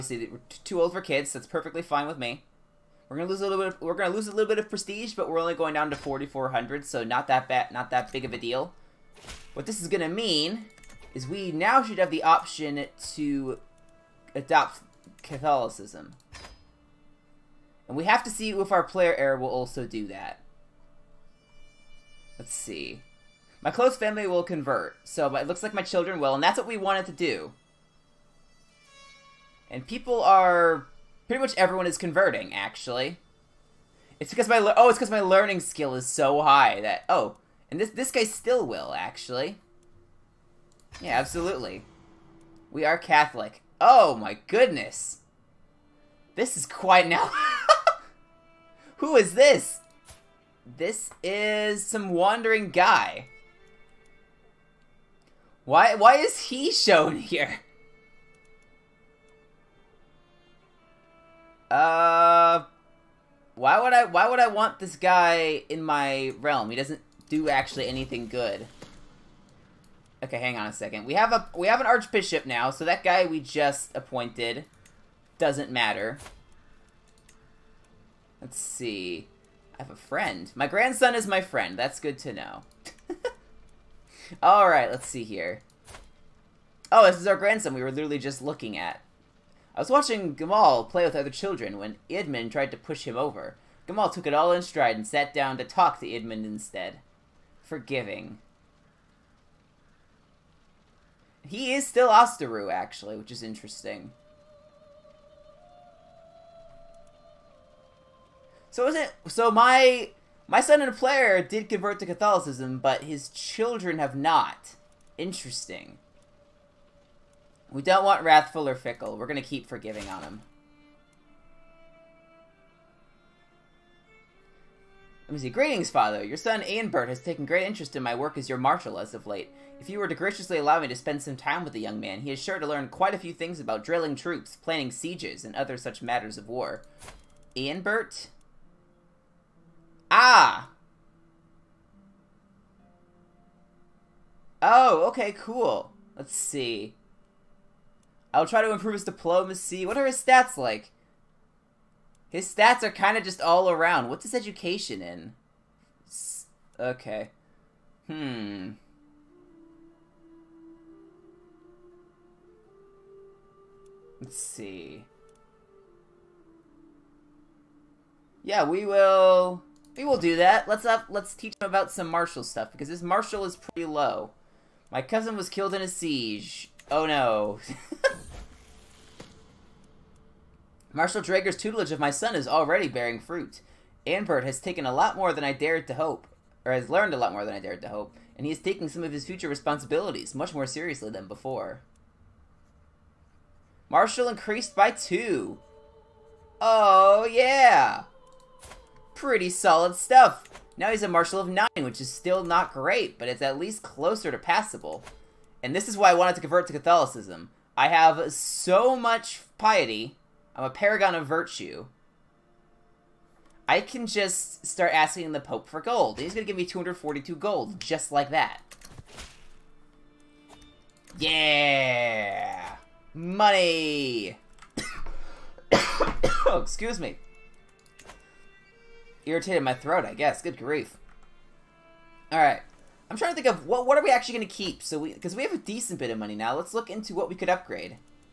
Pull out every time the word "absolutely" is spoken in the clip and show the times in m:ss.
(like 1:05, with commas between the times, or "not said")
0:41.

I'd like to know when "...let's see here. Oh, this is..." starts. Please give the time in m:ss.
1:24.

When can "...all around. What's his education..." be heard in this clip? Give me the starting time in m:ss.
2:33.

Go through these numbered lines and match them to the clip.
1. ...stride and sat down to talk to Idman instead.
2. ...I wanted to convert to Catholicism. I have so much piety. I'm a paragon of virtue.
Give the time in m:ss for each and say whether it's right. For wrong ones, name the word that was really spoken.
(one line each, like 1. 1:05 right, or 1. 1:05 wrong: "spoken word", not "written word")
1. 1:34 right
2. 3:26 right.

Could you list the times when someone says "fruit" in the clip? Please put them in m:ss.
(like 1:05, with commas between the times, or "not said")
3:03.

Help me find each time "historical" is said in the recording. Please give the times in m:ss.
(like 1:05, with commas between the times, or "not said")
not said.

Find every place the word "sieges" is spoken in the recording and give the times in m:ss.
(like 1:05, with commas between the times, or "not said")
2:14, 2:55.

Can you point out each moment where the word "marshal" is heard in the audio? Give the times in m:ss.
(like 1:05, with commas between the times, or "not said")
2:08, 3:00, 3:21.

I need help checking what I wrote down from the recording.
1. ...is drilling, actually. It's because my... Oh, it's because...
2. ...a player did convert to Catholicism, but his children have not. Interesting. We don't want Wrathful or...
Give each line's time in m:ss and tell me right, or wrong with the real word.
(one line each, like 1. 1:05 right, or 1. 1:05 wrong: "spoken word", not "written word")
1. 0:31 wrong: "converting", not "drilling"
2. 1:50 right.